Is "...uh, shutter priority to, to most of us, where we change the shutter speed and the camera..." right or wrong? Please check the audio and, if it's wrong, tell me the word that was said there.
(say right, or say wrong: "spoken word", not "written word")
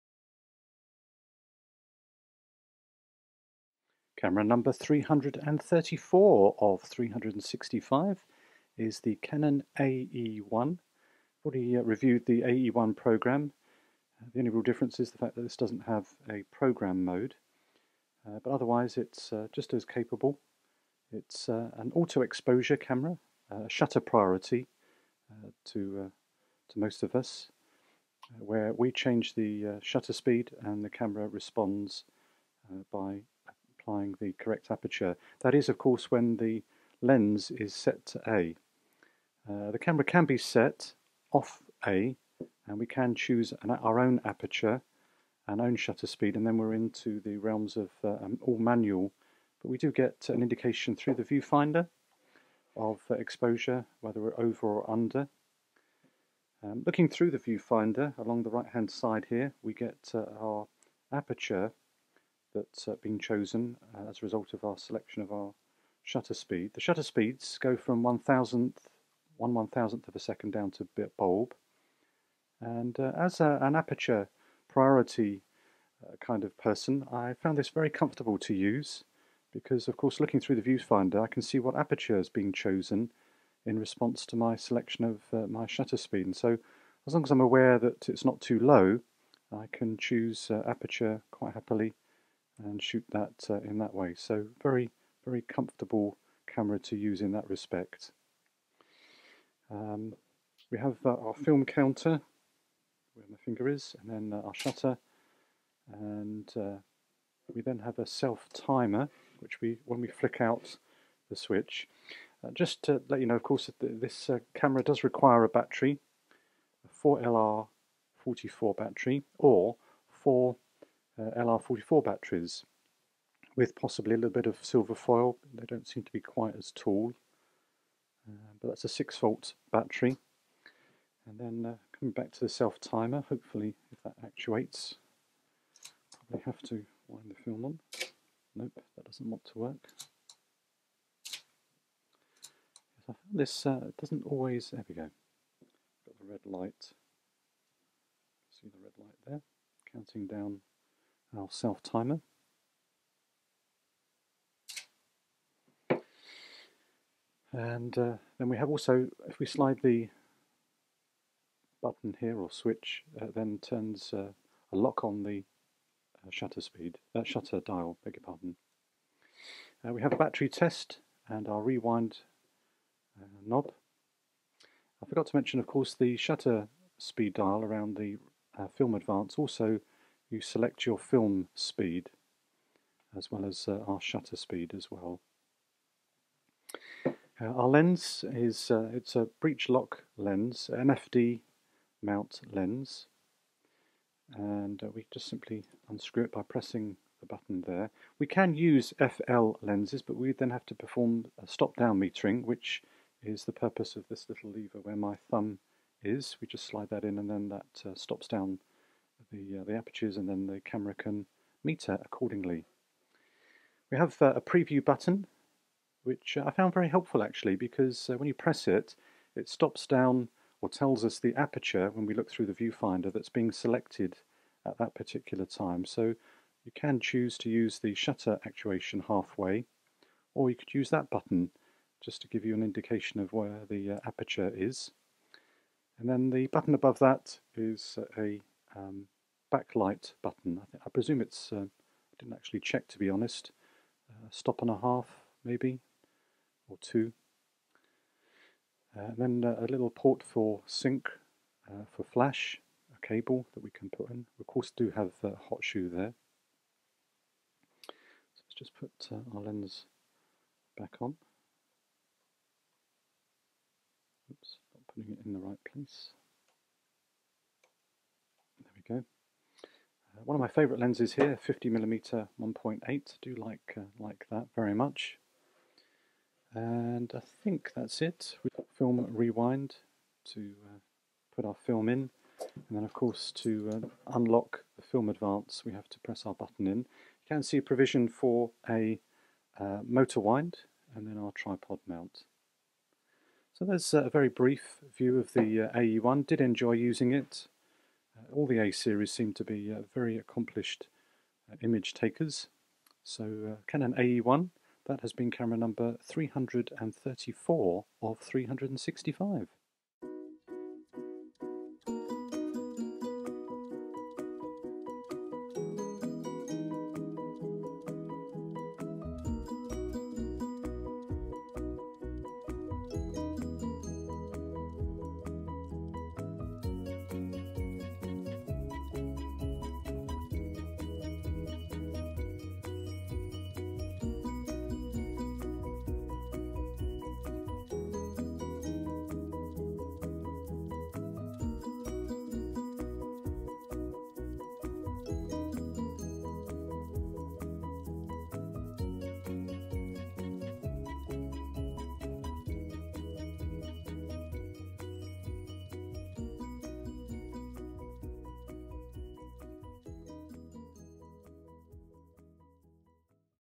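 right.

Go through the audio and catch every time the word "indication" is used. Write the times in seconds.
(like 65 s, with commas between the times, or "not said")
50 s, 232 s.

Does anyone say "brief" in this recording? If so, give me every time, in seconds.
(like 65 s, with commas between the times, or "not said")
294 s.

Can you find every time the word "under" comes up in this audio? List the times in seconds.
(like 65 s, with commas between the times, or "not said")
54 s.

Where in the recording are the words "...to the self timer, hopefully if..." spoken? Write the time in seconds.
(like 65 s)
132 s.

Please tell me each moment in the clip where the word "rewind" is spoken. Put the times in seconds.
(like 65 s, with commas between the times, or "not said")
171 s, 279 s.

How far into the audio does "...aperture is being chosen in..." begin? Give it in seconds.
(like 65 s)
81 s.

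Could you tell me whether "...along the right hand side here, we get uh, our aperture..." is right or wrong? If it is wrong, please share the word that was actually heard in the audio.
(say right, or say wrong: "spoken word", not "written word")
right.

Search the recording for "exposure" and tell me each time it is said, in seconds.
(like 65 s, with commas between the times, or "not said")
21 s, 53 s.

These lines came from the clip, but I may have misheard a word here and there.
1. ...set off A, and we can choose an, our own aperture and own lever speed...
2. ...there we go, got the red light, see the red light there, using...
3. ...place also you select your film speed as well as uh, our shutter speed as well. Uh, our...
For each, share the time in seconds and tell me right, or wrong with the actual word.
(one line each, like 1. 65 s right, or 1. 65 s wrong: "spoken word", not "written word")
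1. 40 s wrong: "shutter", not "lever"
2. 144 s wrong: "counting", not "using"
3. 178 s wrong: "advance", not "place".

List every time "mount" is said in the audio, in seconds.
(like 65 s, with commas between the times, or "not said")
192 s, 291 s.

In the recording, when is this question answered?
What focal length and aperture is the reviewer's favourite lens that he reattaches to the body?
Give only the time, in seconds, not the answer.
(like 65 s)
271 s.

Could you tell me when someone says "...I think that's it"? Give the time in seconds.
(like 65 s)
277 s.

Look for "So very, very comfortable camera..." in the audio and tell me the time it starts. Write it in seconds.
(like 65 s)
94 s.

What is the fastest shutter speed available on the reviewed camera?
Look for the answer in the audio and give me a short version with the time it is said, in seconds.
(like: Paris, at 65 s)
1/1000th of a second, at 69 s.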